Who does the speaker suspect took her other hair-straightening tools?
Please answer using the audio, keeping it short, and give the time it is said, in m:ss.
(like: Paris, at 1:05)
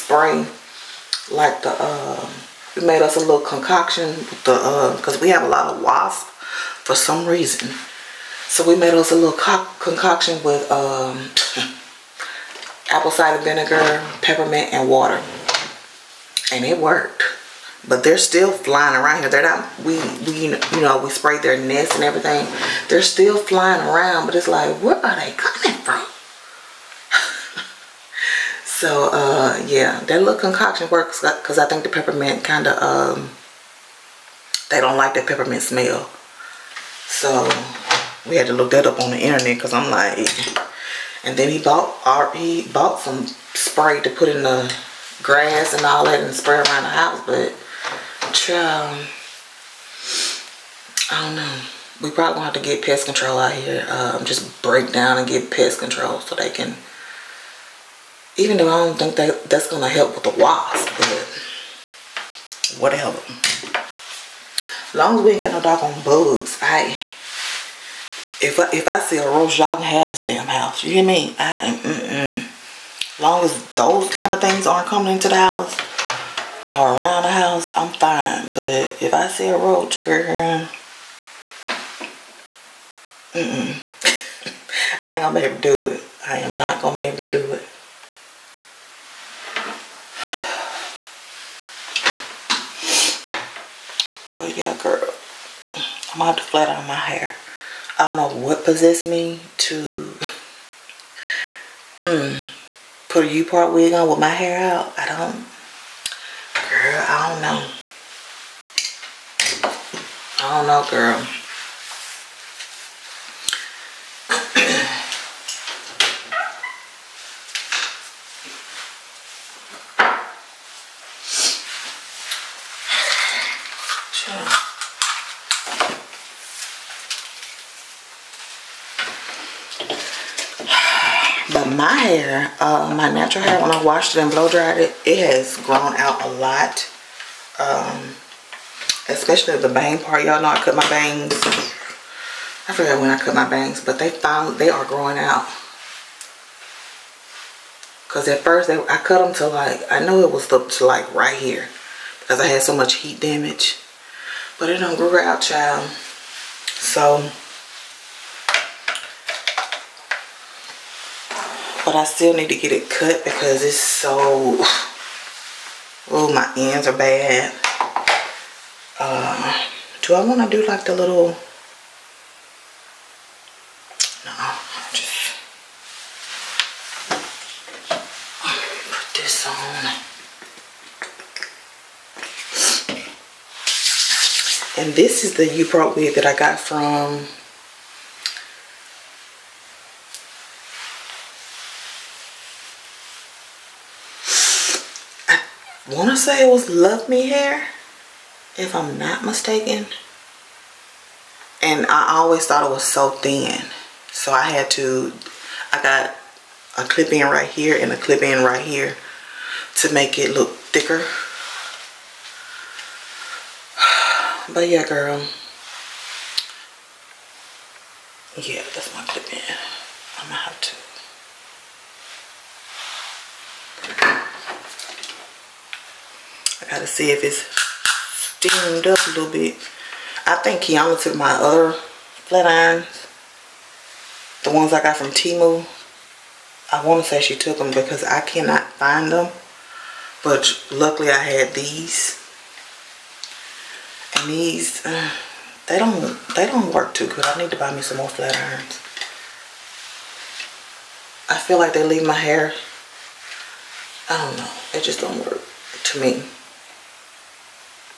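Kiana, at 3:50.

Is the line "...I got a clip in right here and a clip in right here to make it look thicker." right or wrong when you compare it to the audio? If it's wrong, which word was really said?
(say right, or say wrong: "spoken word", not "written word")
right.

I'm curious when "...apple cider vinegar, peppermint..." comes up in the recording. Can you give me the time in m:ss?
0:12.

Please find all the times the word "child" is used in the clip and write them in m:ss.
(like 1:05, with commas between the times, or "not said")
0:48, 2:35.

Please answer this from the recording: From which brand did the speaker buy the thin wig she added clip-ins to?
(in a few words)
Luvme Hair.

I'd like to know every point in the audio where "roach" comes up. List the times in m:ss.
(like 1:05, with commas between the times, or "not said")
1:09, 1:19.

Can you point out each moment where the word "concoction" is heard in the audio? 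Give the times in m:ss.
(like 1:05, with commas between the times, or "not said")
0:03, 0:09, 0:30.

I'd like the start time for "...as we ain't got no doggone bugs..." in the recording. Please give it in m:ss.
1:05.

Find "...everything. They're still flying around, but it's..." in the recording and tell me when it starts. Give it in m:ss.
0:22.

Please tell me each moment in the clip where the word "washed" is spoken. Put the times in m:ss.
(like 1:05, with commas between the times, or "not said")
2:13.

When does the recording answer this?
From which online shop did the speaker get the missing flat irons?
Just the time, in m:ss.
3:55.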